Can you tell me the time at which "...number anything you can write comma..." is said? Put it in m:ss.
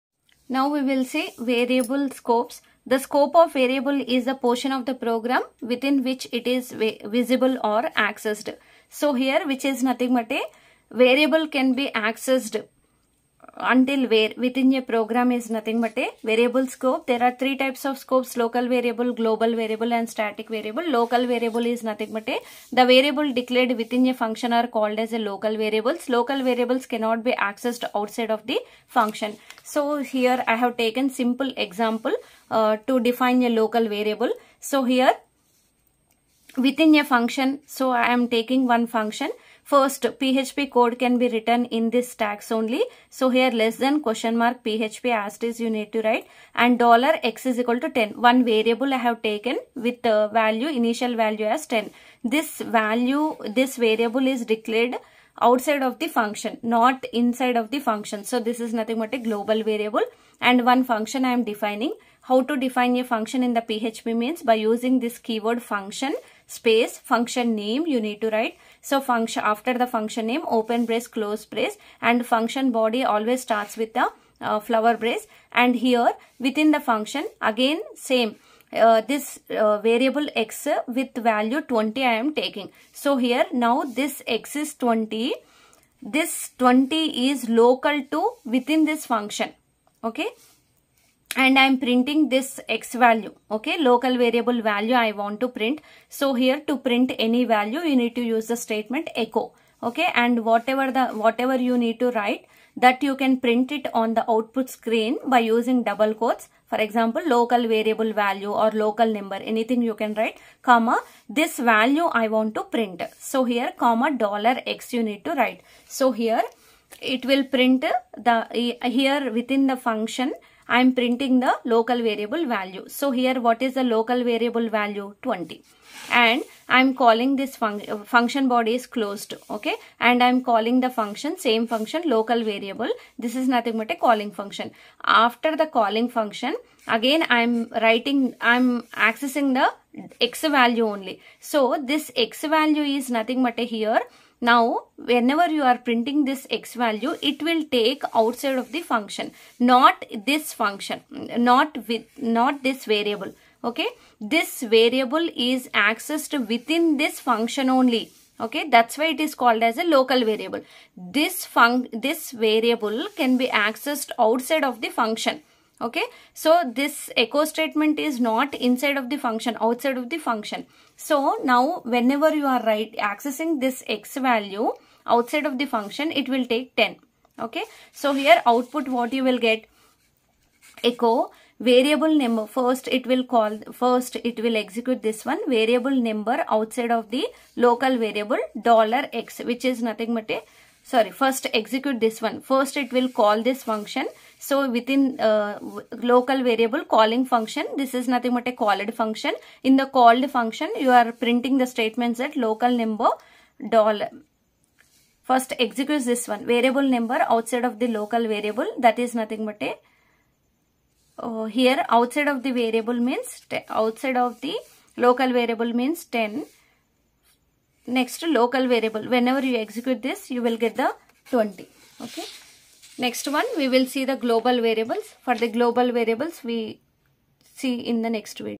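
1:49.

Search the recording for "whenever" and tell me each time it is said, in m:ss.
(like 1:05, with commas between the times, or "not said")
2:24, 2:51, 3:39.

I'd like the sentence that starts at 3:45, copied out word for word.
For the global variables, we see in the next video.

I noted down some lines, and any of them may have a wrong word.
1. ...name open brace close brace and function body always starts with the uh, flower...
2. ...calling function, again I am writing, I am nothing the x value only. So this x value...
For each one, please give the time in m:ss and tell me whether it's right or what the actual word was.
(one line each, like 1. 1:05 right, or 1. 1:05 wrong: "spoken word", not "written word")
1. 1:10 right
2. 2:15 wrong: "accessing", not "nothing".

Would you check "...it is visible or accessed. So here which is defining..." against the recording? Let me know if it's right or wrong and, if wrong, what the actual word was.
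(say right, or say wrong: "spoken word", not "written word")
wrong: "nothing", not "defining".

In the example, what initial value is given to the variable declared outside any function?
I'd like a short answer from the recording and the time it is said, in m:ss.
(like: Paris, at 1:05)
10, at 0:50.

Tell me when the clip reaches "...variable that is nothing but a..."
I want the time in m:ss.
3:28.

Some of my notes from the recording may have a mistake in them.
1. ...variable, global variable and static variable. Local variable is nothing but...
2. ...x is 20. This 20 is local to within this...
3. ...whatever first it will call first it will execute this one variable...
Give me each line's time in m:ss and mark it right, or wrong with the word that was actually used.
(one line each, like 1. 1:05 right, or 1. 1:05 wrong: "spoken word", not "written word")
1. 0:18 right
2. 1:24 right
3. 3:02 wrong: "number", not "whatever".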